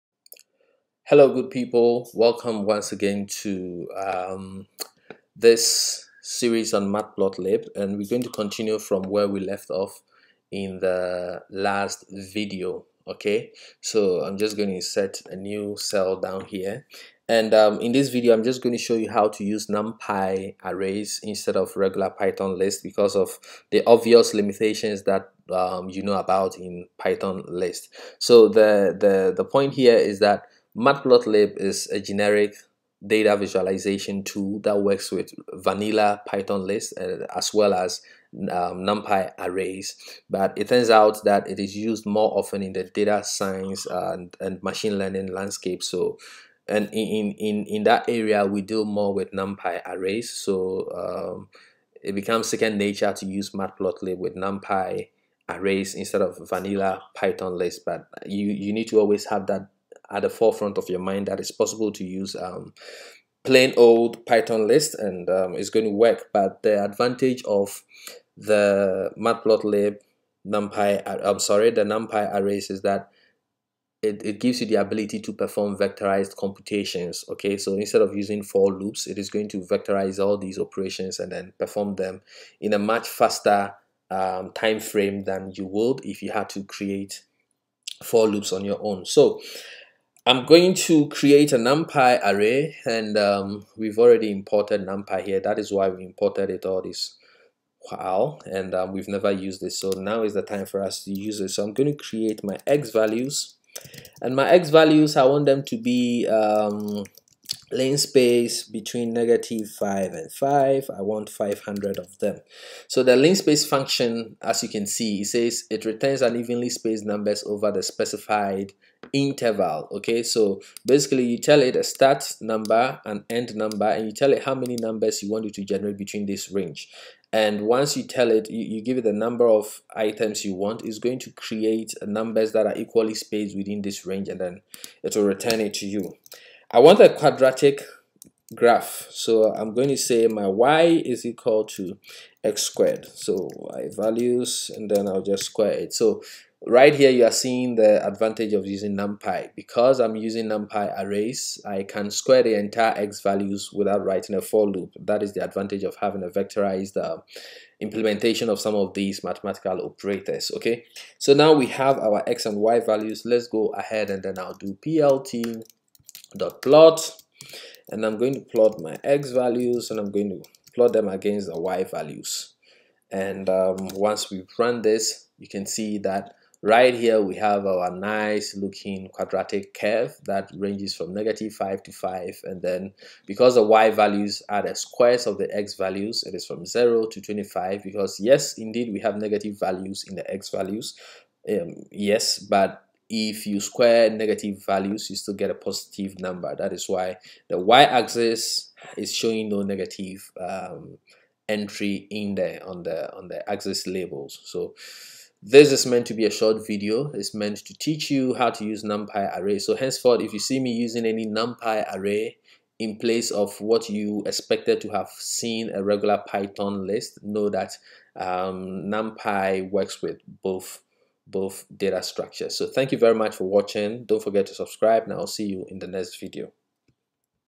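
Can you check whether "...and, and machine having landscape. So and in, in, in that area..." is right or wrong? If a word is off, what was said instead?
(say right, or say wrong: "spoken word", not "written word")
wrong: "learning", not "having".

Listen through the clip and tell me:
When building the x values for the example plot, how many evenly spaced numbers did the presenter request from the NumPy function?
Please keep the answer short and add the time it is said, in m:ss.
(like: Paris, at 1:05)
500, at 1:51.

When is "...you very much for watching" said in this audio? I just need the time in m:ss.
3:42.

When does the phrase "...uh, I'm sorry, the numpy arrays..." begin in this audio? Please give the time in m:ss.
1:11.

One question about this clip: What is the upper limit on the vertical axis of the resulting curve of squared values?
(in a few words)
25.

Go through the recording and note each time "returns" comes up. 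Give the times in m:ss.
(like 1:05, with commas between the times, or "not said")
1:55, 2:15.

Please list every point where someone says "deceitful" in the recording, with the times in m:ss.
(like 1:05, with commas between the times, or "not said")
not said.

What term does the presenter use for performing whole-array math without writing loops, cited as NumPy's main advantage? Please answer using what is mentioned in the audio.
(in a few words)
vectorized computations.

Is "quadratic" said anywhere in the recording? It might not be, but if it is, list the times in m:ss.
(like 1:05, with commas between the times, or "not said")
2:17, 2:59.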